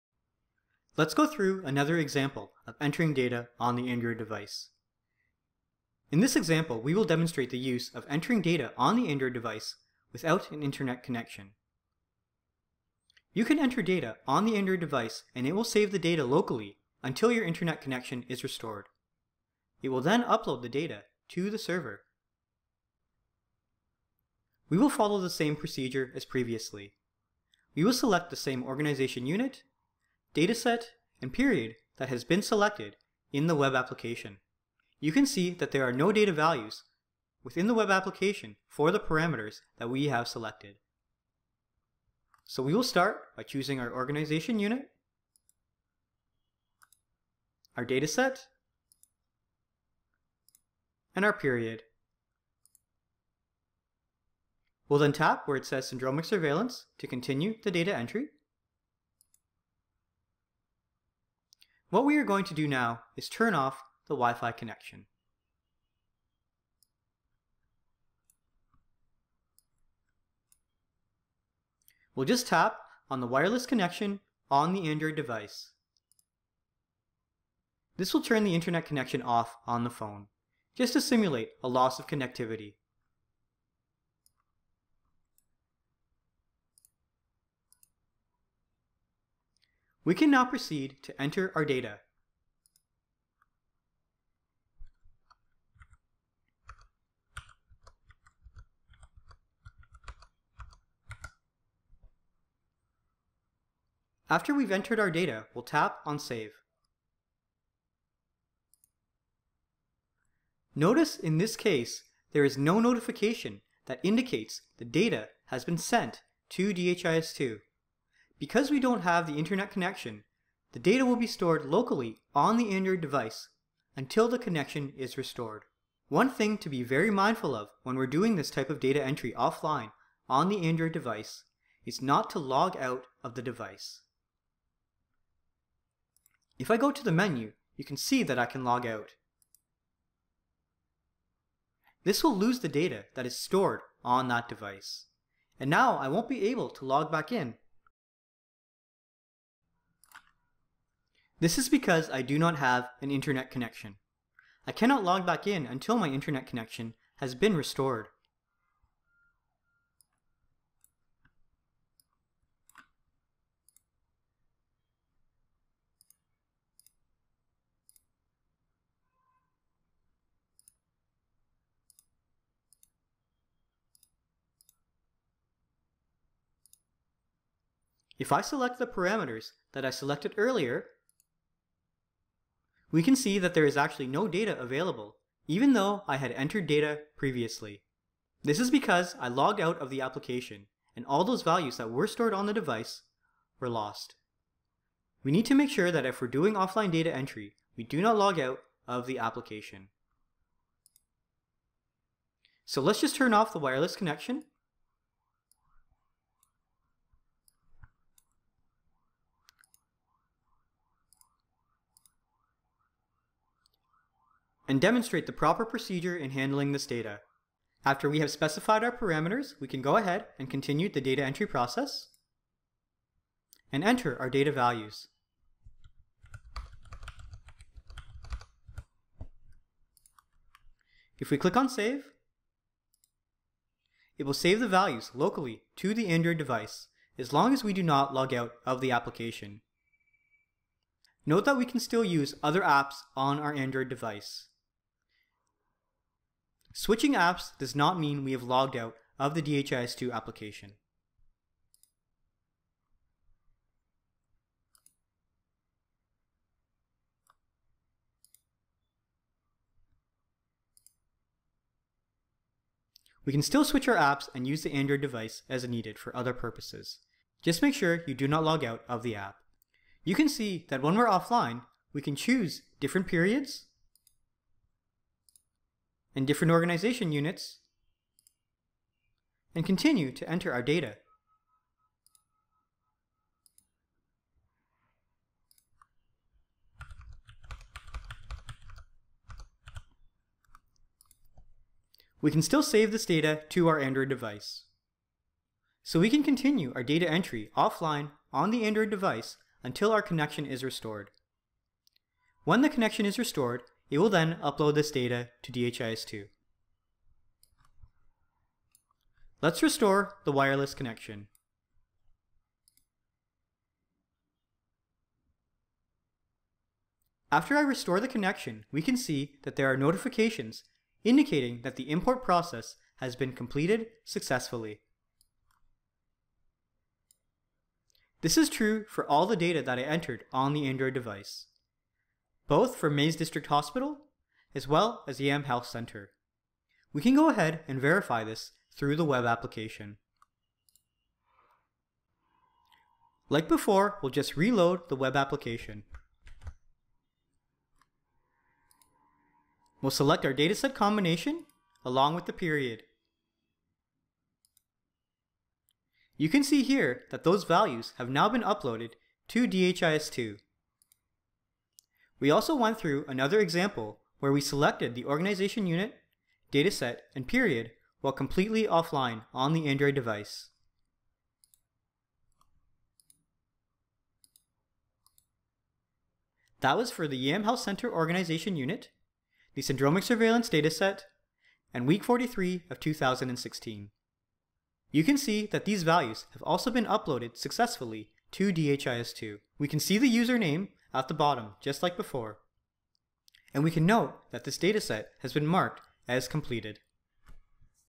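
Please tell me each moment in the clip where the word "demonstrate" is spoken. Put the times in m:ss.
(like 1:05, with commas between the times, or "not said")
0:07, 3:34.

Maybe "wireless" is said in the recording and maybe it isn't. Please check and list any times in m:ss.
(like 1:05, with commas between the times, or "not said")
1:13, 3:23, 5:10.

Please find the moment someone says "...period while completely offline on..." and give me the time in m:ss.
6:07.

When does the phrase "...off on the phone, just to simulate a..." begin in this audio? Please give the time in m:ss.
1:19.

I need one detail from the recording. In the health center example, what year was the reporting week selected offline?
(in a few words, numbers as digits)
2016.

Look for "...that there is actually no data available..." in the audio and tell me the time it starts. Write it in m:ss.
3:03.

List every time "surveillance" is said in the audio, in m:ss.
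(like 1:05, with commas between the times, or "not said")
0:56, 6:20.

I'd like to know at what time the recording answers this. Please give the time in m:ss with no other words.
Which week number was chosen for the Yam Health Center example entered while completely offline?
6:21.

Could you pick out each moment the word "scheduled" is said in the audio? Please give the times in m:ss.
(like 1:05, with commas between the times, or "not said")
not said.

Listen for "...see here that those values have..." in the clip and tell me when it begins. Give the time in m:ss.
5:56.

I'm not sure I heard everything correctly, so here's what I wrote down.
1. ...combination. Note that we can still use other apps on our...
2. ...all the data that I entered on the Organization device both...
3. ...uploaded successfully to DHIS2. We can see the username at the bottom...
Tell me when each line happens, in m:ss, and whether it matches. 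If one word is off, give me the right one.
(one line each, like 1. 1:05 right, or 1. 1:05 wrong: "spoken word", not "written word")
1. 3:58 wrong: "application", not "combination"
2. 5:29 wrong: "Android", not "Organization"
3. 6:26 right.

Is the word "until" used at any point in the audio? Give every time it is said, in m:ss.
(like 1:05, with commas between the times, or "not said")
0:17, 2:03, 2:35, 4:59.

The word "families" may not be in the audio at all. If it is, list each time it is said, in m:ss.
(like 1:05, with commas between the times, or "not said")
not said.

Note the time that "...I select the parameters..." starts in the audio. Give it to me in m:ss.
2:58.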